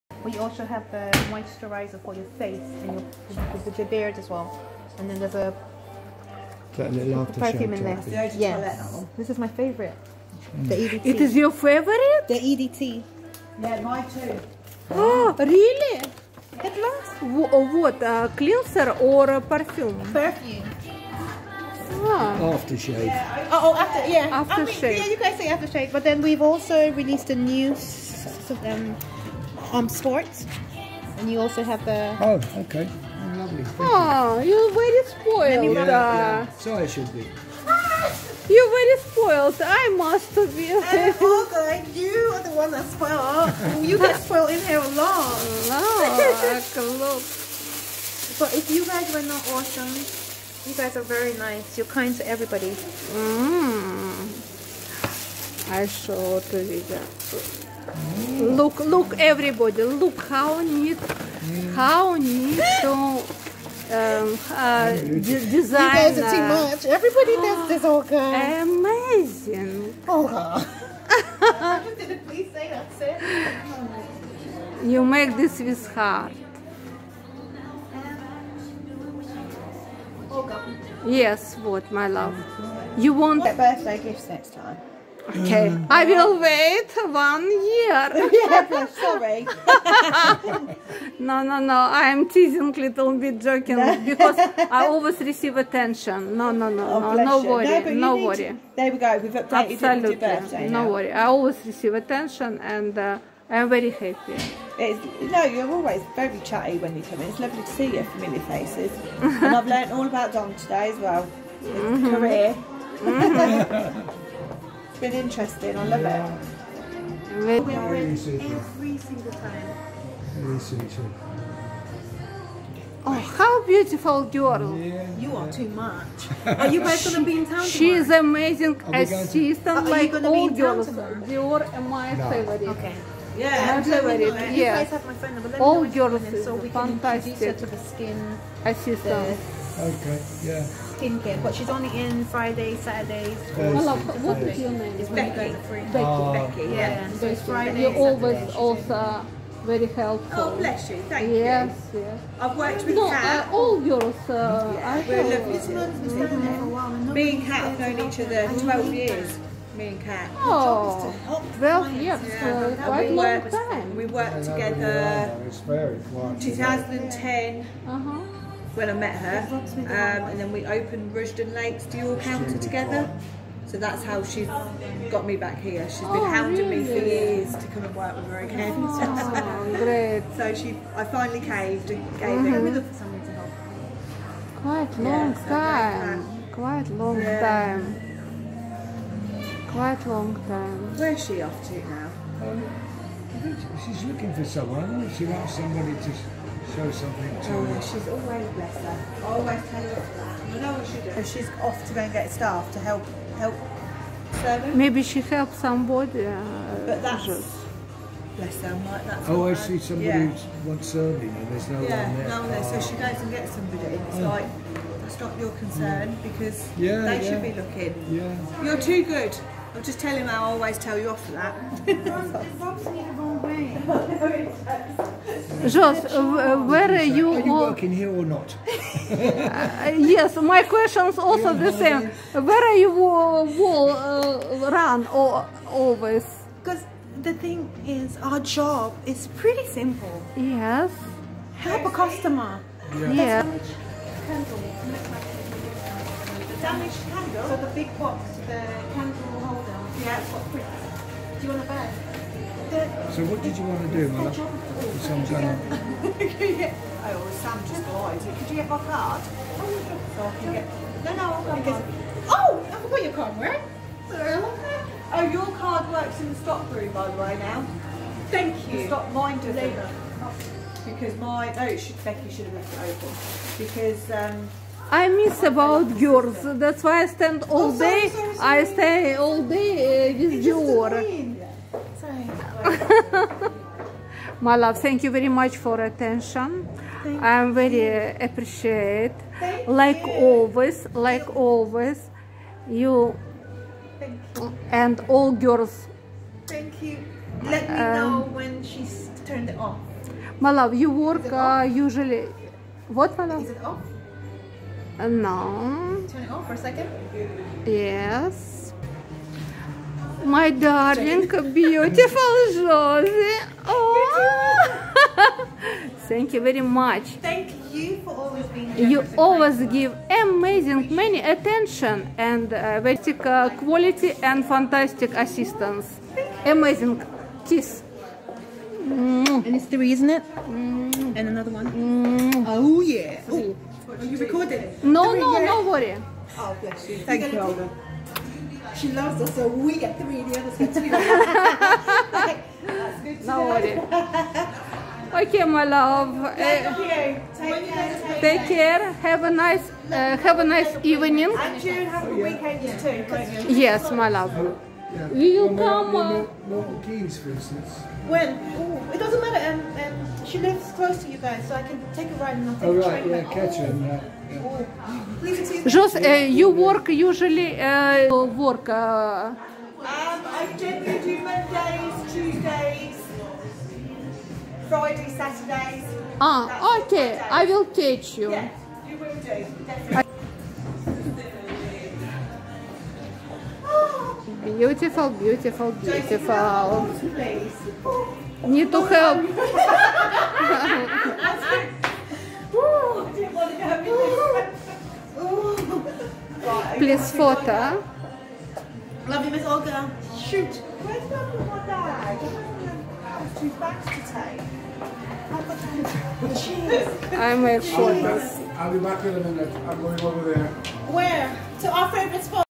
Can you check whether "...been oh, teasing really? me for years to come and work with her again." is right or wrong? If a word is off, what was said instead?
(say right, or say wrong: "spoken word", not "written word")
wrong: "hounding", not "teasing".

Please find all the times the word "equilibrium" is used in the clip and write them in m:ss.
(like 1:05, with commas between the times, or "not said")
not said.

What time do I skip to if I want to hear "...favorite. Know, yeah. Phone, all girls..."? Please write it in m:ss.
2:13.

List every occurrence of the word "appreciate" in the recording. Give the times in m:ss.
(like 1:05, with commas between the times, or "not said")
4:48.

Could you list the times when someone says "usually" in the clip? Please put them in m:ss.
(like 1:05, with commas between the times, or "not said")
5:01, 6:06.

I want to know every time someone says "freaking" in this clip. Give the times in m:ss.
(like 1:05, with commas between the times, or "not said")
not said.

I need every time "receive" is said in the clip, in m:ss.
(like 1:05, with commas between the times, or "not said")
1:35, 1:41.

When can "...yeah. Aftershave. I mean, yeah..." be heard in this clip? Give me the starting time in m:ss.
0:24.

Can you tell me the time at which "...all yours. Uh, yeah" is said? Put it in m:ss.
2:33.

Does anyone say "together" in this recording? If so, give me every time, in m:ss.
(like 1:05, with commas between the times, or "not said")
2:44, 2:52.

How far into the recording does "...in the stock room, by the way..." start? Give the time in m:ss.
4:26.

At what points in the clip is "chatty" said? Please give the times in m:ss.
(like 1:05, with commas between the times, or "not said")
1:46.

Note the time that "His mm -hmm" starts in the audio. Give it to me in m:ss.
1:51.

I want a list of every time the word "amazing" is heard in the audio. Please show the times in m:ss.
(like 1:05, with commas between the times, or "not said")
1:08, 2:08, 5:20, 5:26.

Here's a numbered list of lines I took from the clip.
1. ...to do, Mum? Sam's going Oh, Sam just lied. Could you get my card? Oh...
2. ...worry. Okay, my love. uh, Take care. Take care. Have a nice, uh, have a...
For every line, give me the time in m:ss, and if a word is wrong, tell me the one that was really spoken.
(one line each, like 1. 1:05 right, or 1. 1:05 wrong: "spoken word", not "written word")
1. 4:13 right
2. 5:43 right.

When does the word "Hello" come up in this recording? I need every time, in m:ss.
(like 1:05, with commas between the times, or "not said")
2:23.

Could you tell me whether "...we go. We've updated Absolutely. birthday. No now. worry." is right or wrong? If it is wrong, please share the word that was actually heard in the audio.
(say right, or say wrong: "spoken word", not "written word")
right.